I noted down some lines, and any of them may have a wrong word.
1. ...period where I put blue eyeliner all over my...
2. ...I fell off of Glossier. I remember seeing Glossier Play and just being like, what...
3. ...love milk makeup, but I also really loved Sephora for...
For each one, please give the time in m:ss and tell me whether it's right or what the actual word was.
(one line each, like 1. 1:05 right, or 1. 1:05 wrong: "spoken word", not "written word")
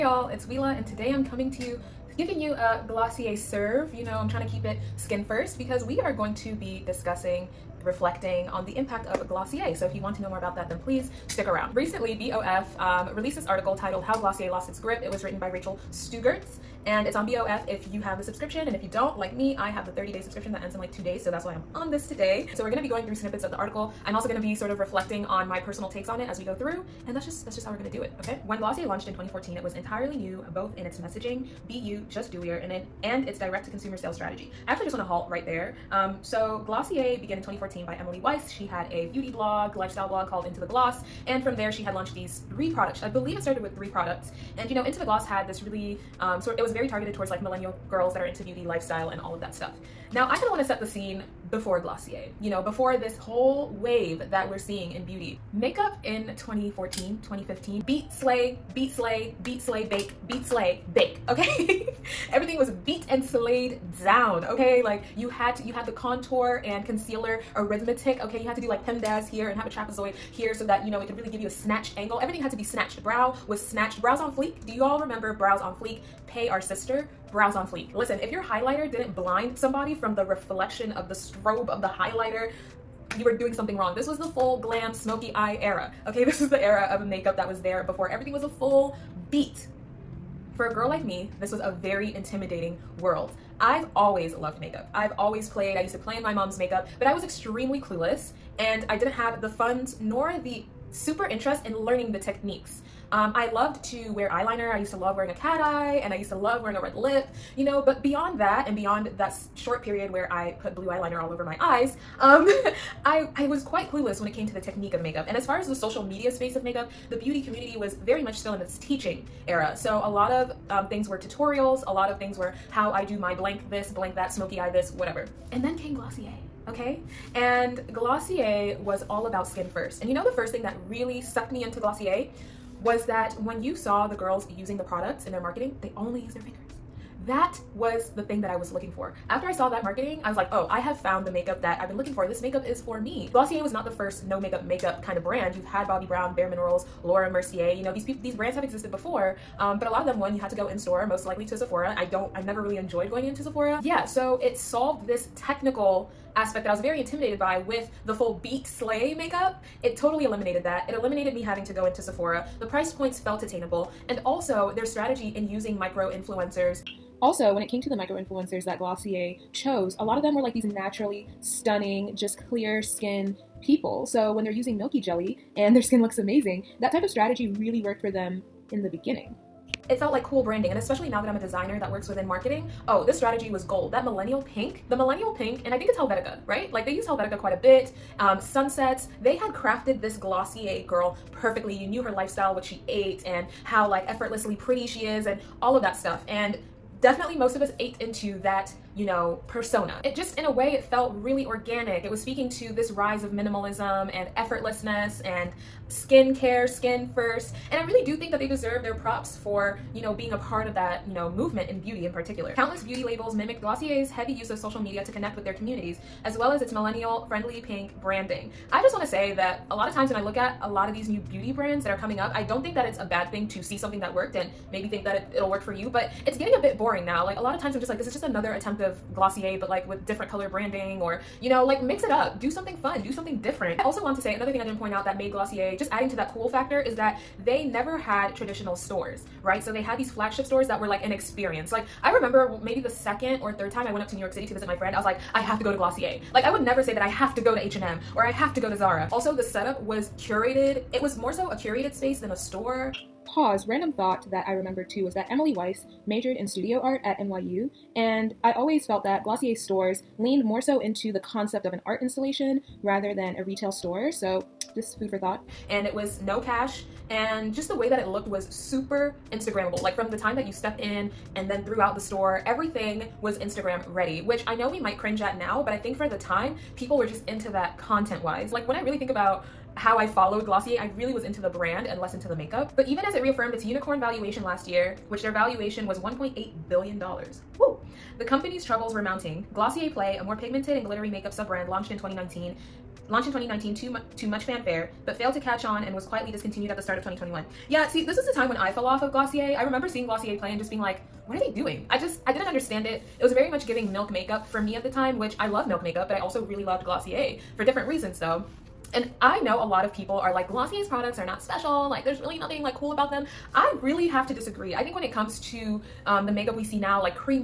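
1. 1:49 right
2. 4:58 right
3. 5:05 wrong: "Glossier", not "Sephora".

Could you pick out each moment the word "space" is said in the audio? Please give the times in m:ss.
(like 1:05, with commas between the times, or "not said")
1:56, 4:11.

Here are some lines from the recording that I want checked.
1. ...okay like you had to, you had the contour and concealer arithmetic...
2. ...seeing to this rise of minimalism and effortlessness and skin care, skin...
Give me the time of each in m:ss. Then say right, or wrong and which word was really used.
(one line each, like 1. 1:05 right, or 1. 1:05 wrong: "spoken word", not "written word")
1. 1:04 right
2. 3:22 wrong: "speaking", not "seeing".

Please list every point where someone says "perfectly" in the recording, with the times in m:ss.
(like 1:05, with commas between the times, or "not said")
3:11.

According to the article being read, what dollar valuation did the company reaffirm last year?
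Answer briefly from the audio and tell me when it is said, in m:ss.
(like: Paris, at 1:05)
$1.8 billion, at 4:45.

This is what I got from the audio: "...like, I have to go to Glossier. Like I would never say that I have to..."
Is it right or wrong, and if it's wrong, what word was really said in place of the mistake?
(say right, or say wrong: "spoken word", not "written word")
right.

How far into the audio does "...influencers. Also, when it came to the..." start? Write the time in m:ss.
2:46.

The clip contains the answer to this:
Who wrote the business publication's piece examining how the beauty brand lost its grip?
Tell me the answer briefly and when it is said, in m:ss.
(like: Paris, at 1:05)
Rachel Strugatz, at 0:15.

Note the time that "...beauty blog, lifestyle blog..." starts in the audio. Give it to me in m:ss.
0:39.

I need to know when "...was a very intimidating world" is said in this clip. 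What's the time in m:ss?
1:31.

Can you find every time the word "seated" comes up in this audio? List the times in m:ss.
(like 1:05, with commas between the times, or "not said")
not said.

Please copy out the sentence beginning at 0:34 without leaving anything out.
I actually just want to halt right there.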